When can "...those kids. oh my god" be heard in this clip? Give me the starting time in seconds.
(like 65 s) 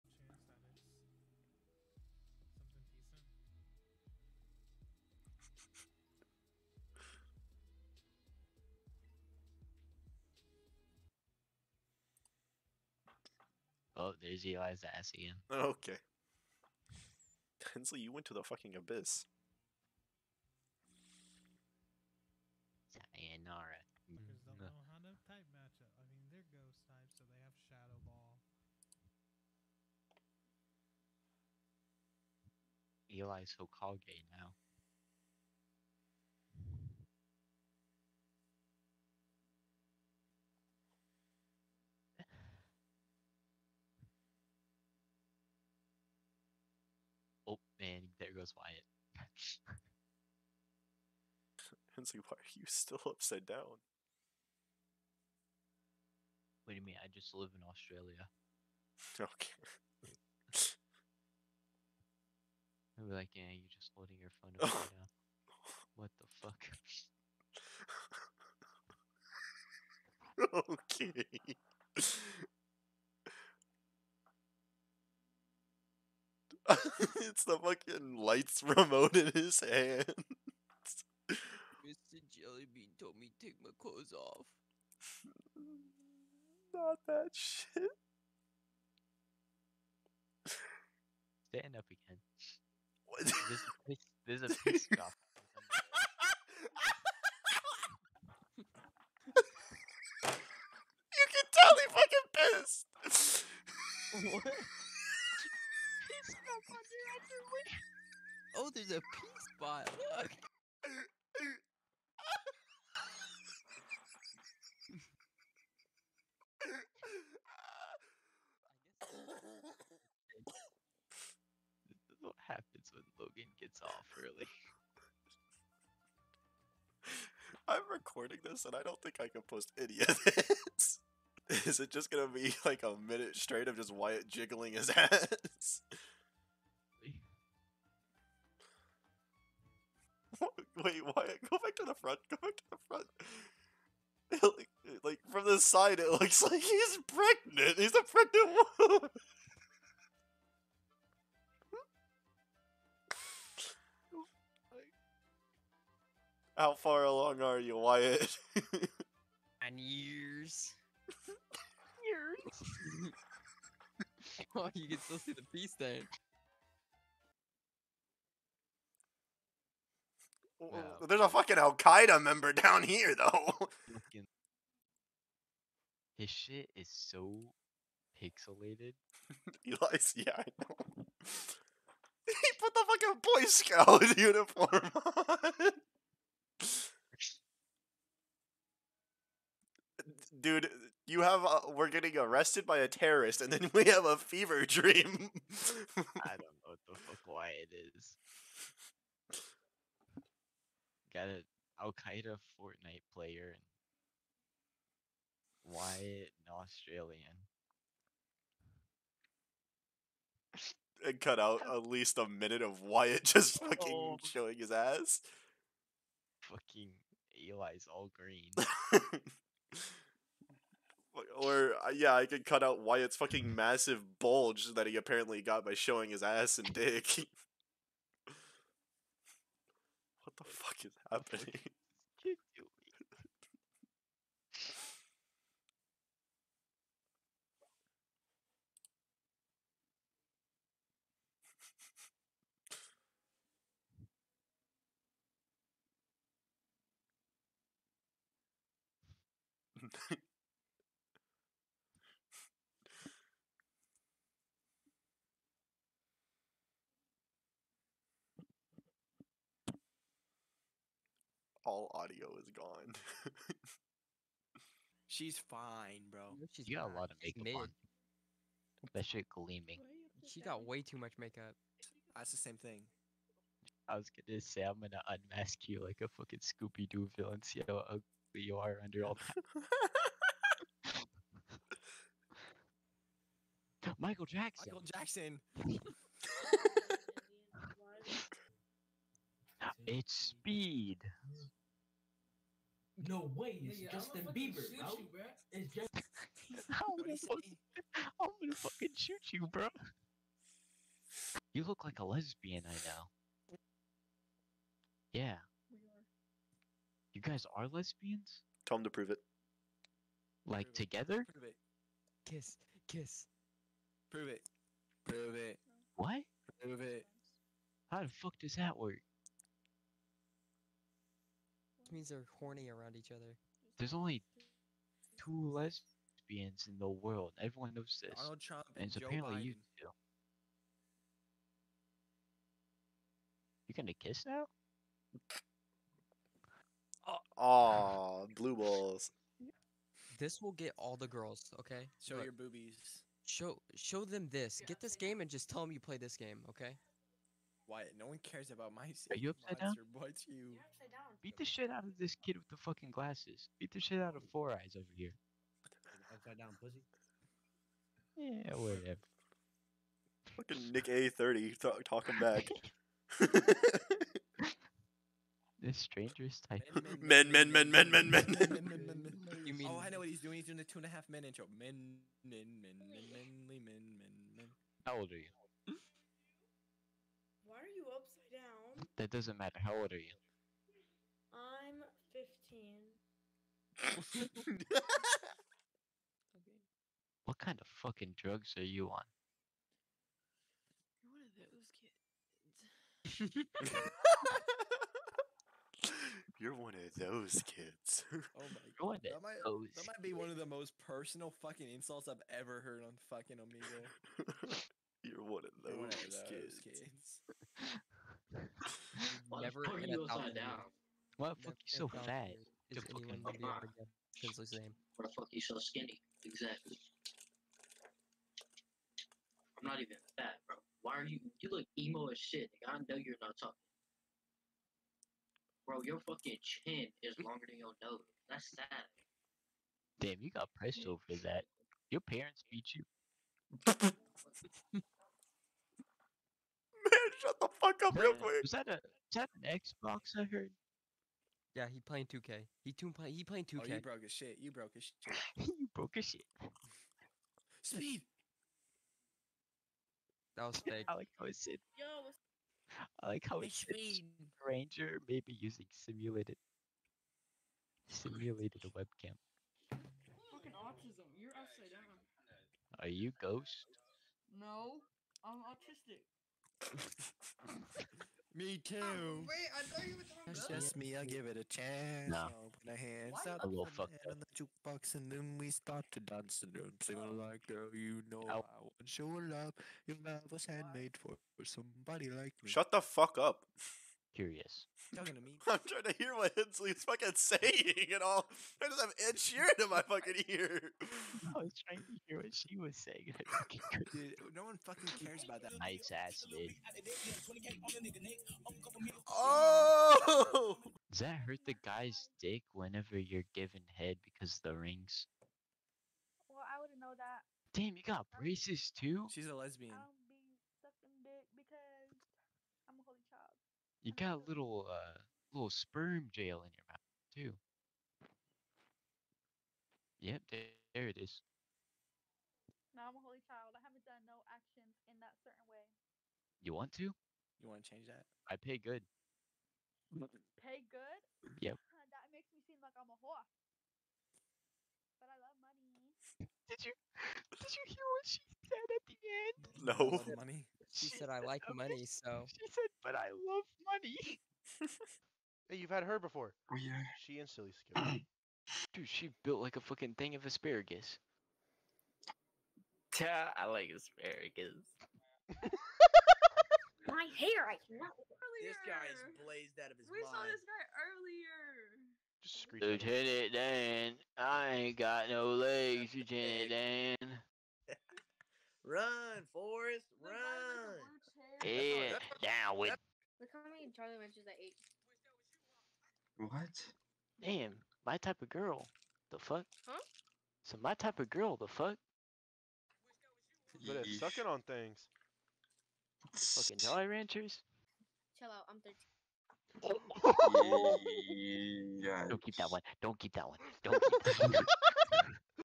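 398 s.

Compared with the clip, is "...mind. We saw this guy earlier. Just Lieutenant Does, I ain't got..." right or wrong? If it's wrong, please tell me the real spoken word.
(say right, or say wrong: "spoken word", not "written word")
wrong: "Dan", not "Does".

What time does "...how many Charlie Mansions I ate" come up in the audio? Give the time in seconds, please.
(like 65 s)
573 s.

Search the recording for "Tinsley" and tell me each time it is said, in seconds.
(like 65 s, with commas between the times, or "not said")
17 s.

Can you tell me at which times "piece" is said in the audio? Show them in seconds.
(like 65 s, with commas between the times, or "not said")
93 s.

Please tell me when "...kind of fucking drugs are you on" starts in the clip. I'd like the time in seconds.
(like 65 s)
387 s.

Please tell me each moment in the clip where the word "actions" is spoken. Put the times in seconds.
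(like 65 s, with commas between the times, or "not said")
524 s.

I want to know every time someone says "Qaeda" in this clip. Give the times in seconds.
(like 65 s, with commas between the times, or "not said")
171 s, 201 s.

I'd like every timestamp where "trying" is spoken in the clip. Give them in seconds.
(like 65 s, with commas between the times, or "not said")
485 s, 491 s.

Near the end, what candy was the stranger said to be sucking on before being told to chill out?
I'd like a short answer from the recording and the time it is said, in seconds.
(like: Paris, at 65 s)
Jolly Ranchers, at 586 s.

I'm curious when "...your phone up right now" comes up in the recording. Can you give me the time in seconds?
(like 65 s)
64 s.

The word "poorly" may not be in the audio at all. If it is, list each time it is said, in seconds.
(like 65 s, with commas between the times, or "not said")
not said.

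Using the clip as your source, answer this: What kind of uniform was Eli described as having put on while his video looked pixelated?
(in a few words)
Boy Scout uniform.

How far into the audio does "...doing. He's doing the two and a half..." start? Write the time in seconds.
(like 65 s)
370 s.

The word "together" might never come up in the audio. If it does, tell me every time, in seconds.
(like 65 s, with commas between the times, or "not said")
310 s.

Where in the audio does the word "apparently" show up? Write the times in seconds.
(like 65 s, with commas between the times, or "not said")
224 s, 329 s.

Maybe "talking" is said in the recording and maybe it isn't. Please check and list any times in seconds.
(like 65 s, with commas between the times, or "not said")
361 s, 423 s, 470 s, 484 s.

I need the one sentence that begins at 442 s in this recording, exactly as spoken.
He too play, he playing 2K.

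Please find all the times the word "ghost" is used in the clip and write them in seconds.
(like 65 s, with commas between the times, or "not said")
26 s, 463 s.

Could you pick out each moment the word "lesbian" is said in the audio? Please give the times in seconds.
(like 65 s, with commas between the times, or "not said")
302 s, 307 s, 325 s, 509 s.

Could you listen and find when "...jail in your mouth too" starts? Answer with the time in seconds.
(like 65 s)
516 s.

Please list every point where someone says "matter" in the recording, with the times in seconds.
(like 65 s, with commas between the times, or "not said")
379 s.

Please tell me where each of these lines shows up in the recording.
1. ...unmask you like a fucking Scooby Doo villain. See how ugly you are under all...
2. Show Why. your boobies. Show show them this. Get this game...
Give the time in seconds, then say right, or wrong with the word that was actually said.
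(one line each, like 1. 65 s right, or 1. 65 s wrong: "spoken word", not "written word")
1. 275 s right
2. 342 s wrong: "Look", not "Why".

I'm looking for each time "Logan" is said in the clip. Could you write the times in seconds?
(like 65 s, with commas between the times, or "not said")
123 s.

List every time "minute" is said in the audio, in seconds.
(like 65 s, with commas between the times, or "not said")
133 s, 212 s.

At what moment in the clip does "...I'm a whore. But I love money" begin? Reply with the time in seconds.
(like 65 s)
532 s.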